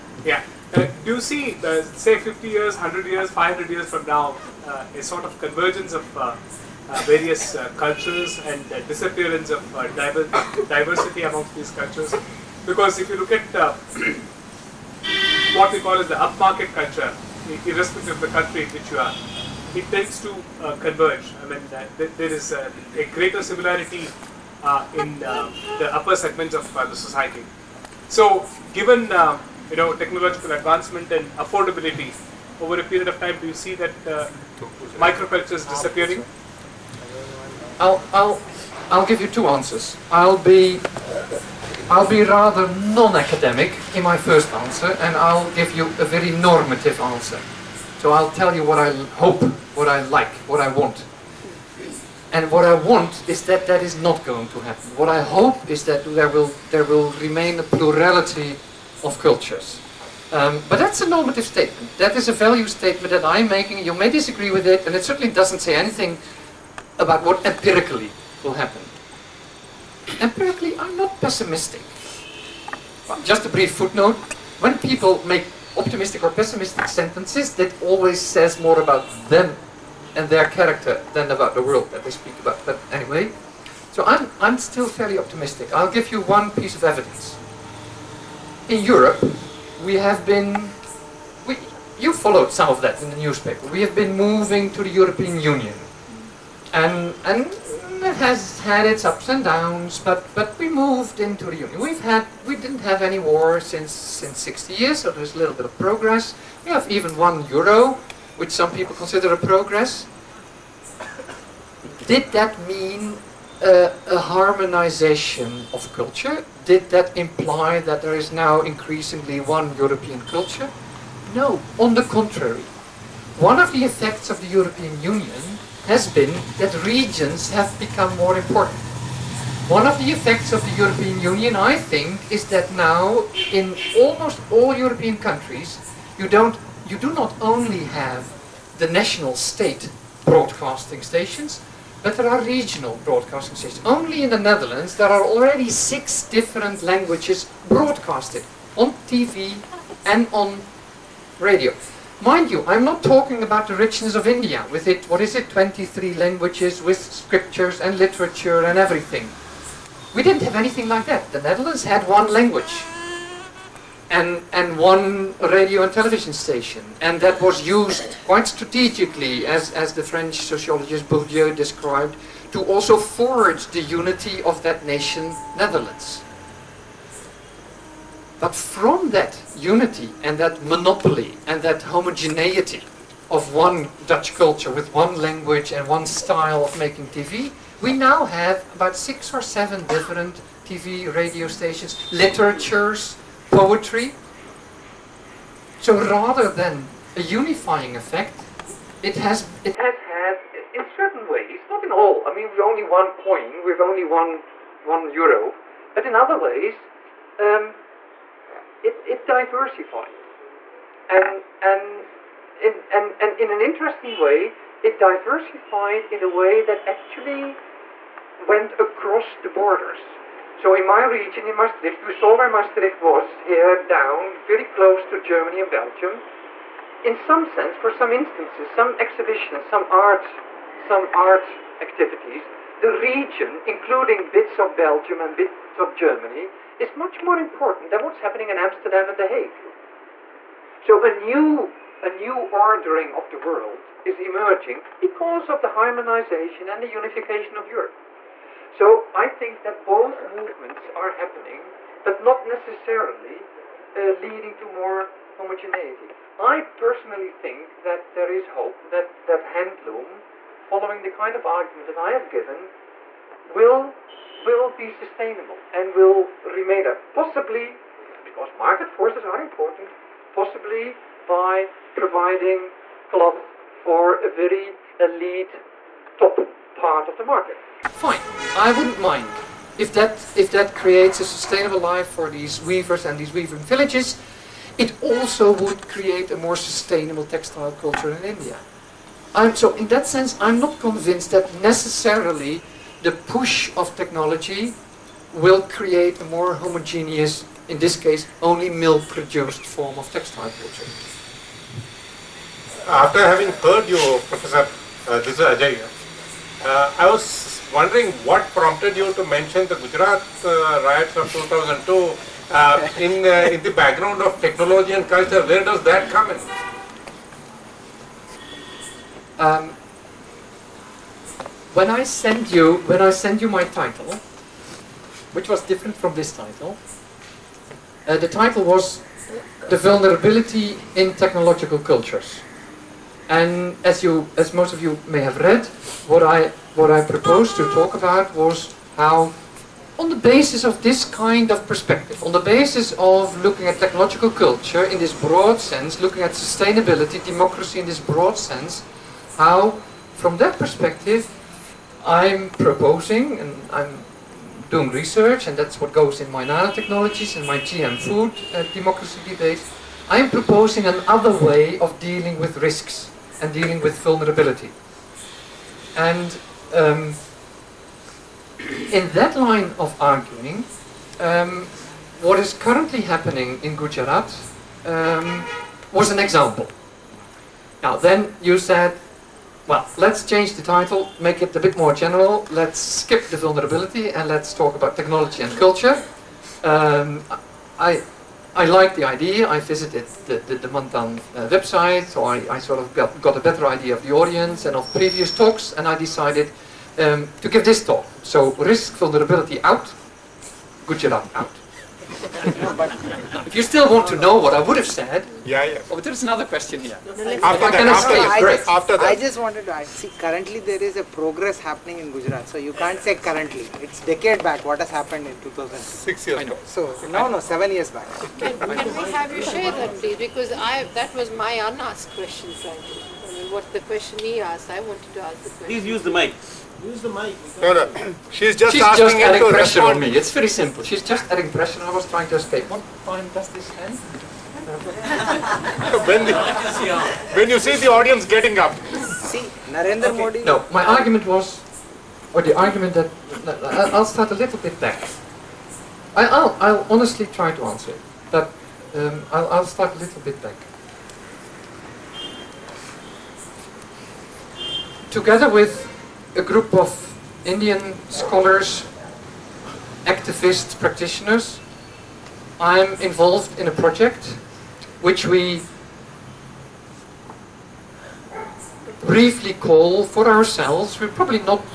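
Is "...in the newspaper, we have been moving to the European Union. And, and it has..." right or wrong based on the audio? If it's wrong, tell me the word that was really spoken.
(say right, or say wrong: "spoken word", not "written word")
right.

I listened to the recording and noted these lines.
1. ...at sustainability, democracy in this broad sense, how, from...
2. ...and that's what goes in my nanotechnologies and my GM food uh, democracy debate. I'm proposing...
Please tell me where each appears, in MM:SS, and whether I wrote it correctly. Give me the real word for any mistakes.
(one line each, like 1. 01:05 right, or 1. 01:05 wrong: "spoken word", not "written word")
1. 05:46 right
2. 05:55 right.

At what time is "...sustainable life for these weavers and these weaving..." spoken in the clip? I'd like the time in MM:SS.
04:41.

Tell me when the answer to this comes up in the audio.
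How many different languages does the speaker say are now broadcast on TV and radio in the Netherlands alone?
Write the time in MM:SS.
02:25.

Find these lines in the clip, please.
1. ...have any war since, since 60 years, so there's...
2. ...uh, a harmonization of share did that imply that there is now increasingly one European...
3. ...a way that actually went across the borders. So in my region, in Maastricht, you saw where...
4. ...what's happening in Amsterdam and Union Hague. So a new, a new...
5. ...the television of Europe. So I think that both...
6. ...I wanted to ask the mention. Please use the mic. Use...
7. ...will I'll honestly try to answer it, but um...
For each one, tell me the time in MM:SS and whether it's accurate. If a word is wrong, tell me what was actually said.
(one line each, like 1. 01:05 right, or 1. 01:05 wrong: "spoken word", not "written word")
1. 01:42 right
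2. 01:53 wrong: "culture", not "share"
3. 03:36 right
4. 03:58 wrong: "The", not "Union"
5. 04:06 wrong: "unification", not "television"
6. 07:04 wrong: "question", not "mention"
7. 07:26 right.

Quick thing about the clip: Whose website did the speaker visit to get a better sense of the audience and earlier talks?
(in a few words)
Manthan.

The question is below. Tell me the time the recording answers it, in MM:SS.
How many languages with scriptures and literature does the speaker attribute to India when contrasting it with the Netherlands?
02:35.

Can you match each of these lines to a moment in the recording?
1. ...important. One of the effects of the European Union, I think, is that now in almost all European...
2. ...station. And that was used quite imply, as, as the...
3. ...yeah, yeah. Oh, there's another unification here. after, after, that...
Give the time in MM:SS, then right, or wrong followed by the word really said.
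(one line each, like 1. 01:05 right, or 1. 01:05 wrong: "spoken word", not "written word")
1. 02:08 right
2. 02:46 wrong: "strategically", not "imply"
3. 06:45 wrong: "question", not "unification".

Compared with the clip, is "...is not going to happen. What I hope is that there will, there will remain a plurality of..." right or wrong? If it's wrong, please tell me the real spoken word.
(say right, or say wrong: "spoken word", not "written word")
right.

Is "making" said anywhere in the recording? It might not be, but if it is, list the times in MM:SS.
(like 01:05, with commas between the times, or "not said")
01:03, 03:06.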